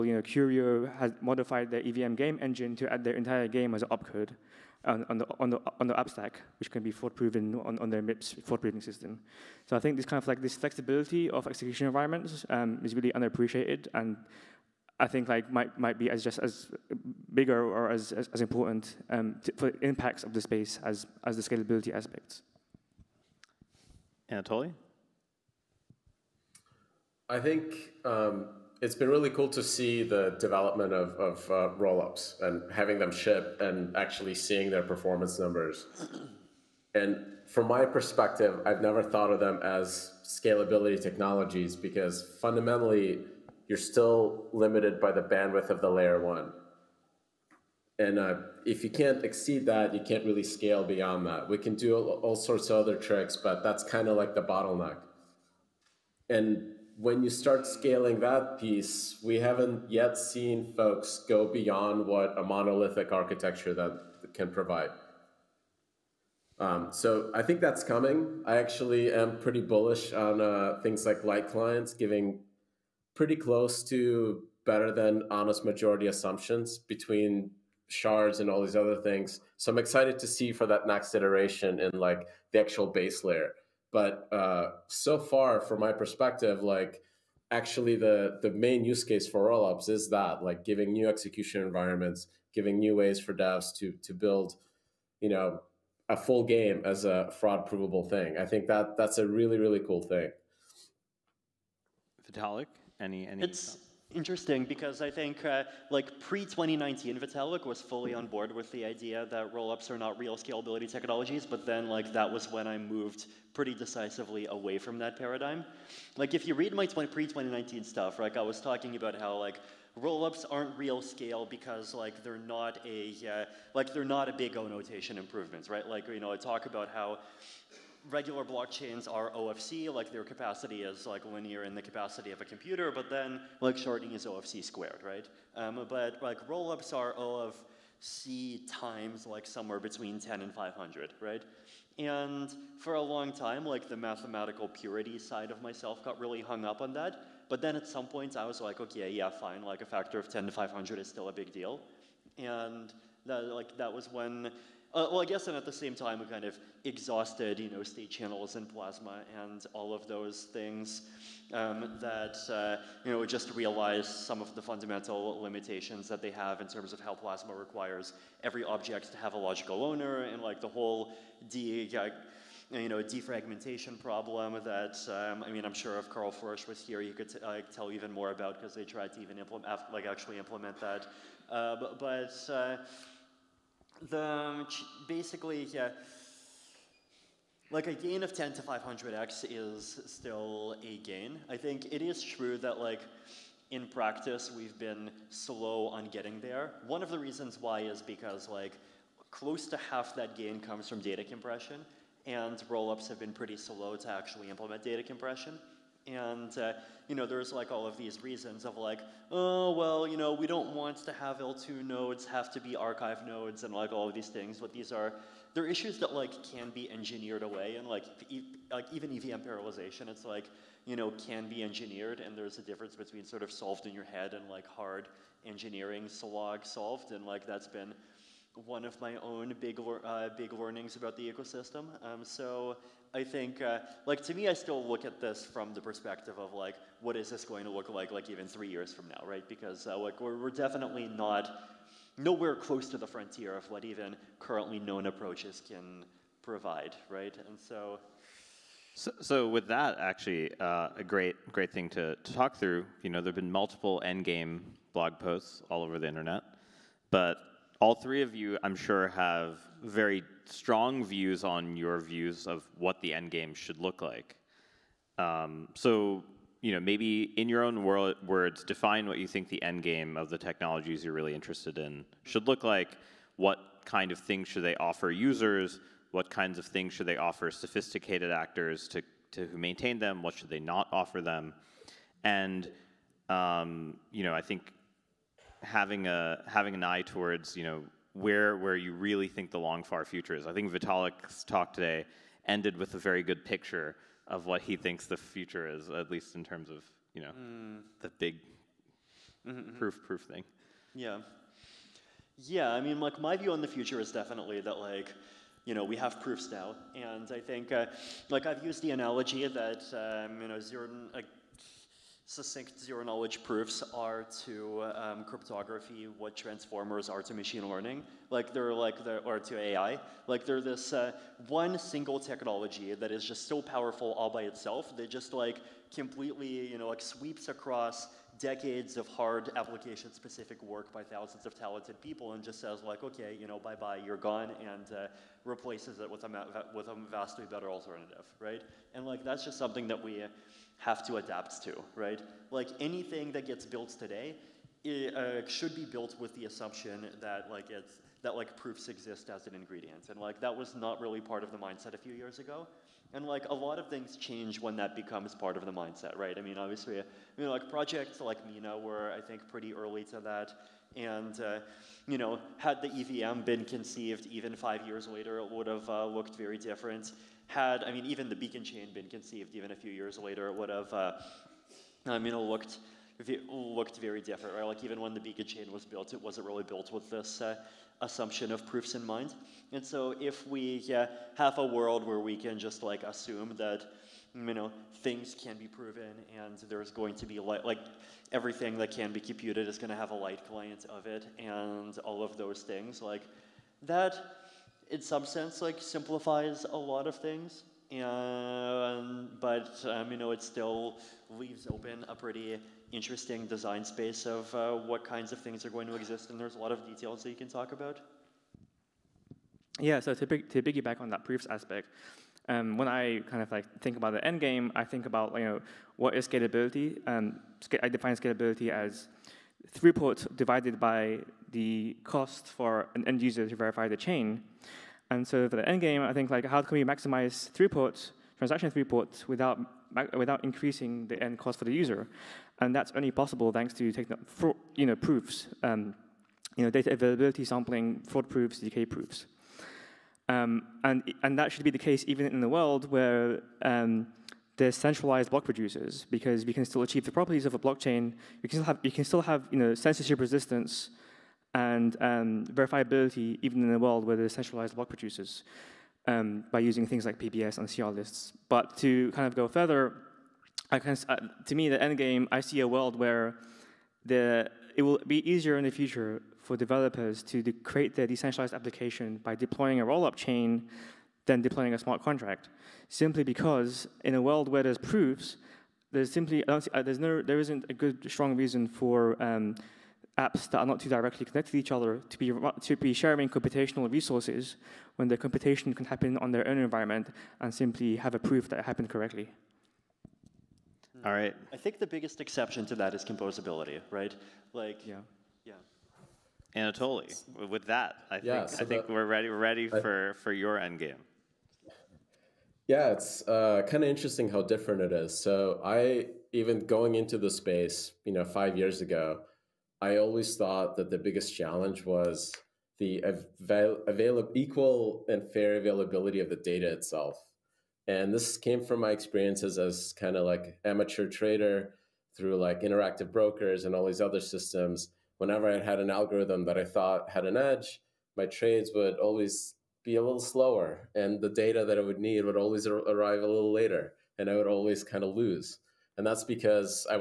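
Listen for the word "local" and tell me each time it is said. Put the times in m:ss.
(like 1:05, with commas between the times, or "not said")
not said.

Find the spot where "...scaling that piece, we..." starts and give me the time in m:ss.
0:57.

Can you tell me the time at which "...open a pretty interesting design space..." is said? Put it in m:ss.
6:41.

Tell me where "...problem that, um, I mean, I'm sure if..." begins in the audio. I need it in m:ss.
2:53.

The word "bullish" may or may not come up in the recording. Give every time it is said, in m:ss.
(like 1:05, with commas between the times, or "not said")
1:09.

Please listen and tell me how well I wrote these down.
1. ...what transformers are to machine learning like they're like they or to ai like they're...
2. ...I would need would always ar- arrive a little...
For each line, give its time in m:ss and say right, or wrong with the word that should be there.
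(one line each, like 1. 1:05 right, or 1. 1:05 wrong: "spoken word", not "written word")
1. 5:16 right
2. 8:51 right.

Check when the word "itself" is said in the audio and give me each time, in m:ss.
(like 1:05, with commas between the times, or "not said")
5:24, 8:36.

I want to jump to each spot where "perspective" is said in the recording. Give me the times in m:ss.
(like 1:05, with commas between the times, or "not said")
0:37, 1:25, 3:55.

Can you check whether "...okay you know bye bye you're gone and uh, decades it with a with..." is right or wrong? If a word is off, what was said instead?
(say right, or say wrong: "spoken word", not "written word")
wrong: "replaces", not "decades".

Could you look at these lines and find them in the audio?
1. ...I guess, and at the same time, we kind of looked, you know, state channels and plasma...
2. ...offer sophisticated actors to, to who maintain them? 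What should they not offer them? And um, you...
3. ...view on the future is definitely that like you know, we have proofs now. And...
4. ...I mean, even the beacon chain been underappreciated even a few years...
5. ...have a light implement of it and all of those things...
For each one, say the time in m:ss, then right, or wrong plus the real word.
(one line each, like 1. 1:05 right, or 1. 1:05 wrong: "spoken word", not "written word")
1. 2:35 wrong: "exhausted", not "looked"
2. 4:37 right
3. 5:03 right
4. 6:07 wrong: "conceived", not "underappreciated"
5. 6:29 wrong: "client", not "implement".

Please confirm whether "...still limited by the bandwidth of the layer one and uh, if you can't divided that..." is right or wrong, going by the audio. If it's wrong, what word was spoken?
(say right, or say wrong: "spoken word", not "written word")
wrong: "exceed", not "divided".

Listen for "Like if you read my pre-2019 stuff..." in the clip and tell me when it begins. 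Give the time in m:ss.
1:56.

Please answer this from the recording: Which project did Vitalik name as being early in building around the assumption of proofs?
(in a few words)
Mina.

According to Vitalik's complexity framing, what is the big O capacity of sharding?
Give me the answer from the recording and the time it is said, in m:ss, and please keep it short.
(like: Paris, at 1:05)
O of C squared, at 2:14.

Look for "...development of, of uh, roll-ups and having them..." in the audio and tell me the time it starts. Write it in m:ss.
0:30.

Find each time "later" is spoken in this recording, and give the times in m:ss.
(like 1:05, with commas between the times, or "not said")
6:05, 6:10, 8:53.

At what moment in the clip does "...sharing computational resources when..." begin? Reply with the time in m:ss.
8:03.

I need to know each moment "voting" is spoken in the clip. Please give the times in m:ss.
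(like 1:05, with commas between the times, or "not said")
not said.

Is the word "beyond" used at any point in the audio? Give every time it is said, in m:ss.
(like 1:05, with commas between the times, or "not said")
0:50, 1:01.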